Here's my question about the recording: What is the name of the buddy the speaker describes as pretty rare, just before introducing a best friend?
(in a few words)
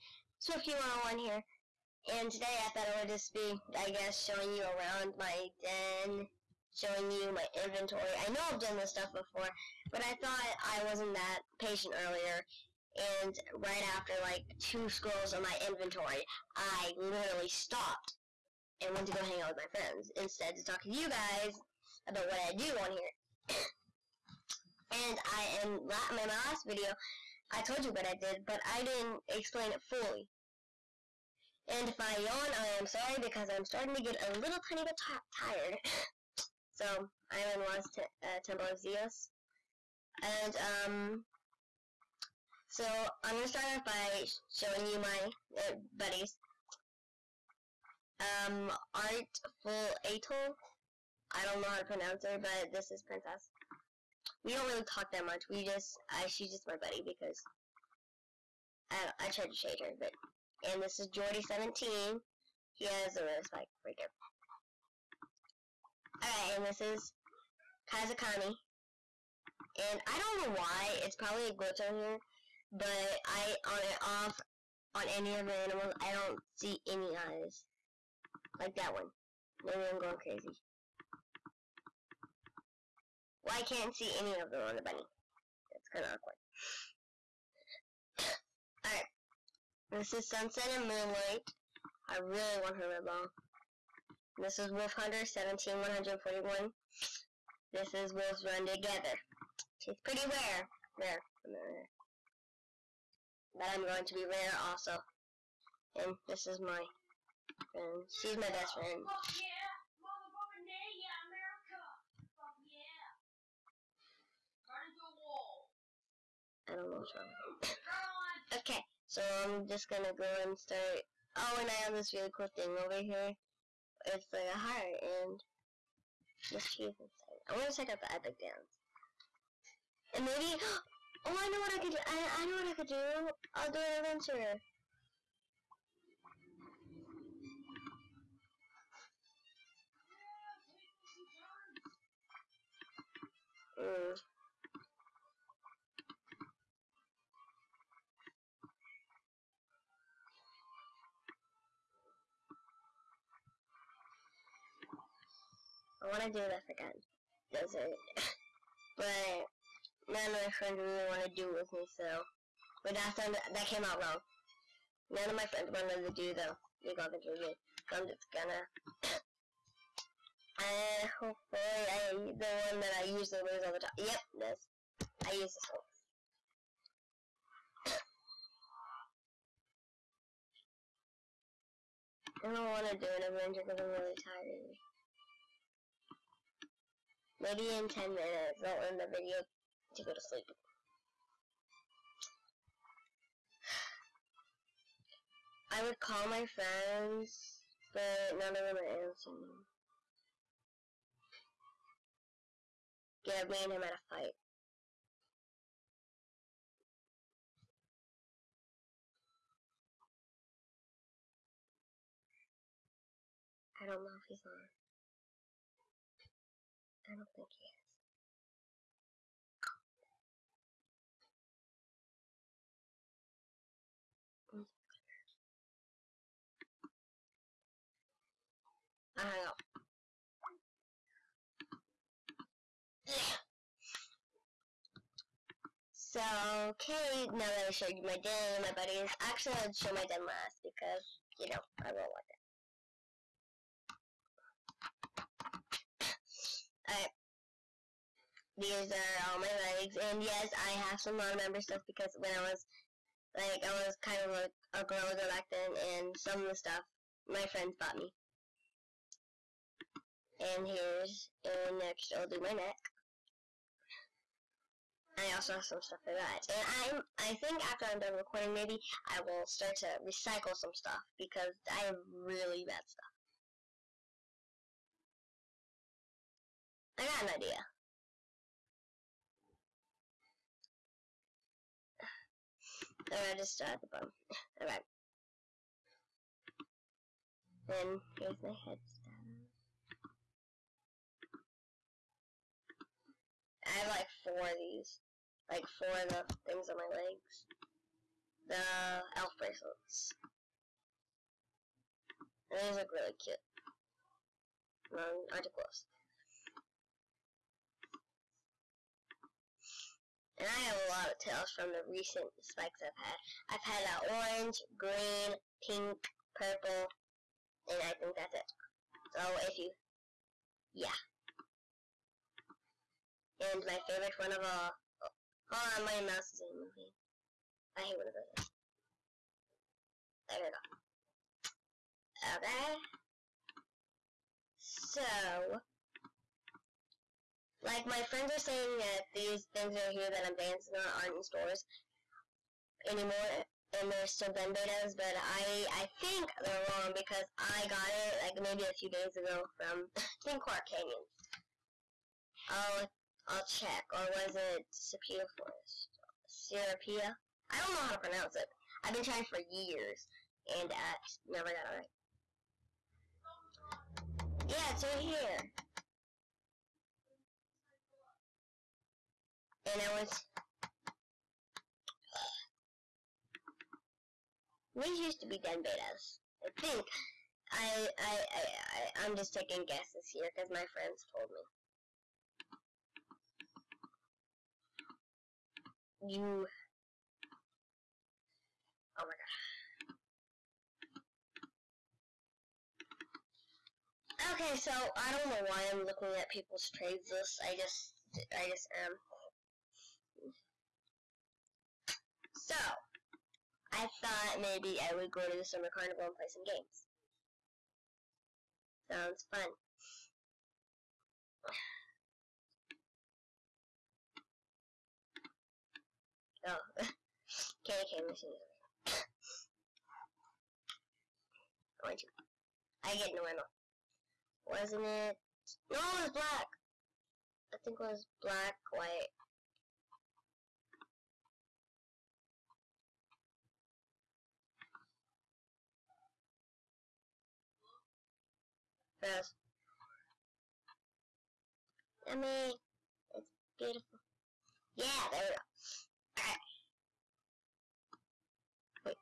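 Wolves Run Together.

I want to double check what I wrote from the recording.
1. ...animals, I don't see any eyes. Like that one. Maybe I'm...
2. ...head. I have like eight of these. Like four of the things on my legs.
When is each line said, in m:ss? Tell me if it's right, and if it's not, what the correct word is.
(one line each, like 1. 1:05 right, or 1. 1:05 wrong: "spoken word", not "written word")
1. 1:15 right
2. 4:48 wrong: "four", not "eight".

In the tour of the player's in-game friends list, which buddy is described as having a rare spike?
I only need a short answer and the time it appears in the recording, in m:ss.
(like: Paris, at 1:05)
Jordy17, at 1:01.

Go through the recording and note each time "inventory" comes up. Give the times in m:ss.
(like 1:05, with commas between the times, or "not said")
0:07, 0:15.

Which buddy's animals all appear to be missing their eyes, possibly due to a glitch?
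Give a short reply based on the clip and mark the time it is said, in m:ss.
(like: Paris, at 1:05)
Kazakami, at 1:07.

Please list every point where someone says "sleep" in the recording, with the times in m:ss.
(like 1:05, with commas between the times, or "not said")
3:10.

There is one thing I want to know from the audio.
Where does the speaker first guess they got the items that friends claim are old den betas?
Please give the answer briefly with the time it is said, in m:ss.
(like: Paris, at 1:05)
Clark Canyon, at 5:50.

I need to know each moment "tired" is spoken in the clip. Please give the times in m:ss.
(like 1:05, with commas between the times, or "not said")
0:35, 3:04.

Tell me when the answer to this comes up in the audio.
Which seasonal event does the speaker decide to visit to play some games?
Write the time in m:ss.
6:45.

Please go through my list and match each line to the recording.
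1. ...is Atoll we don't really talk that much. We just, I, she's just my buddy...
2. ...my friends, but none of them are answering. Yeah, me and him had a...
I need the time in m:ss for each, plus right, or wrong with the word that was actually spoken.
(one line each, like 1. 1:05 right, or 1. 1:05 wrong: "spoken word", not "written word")
1. 0:52 wrong: "Princess", not "Atoll"
2. 3:16 right.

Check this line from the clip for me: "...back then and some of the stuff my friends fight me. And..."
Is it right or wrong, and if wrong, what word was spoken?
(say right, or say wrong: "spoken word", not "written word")
wrong: "bought", not "fight".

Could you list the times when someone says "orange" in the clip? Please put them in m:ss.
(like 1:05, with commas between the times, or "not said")
5:14, 7:01.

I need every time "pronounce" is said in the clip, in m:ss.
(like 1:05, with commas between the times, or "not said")
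0:51, 5:57.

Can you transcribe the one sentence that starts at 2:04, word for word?
It's like a heart and just cheese inside.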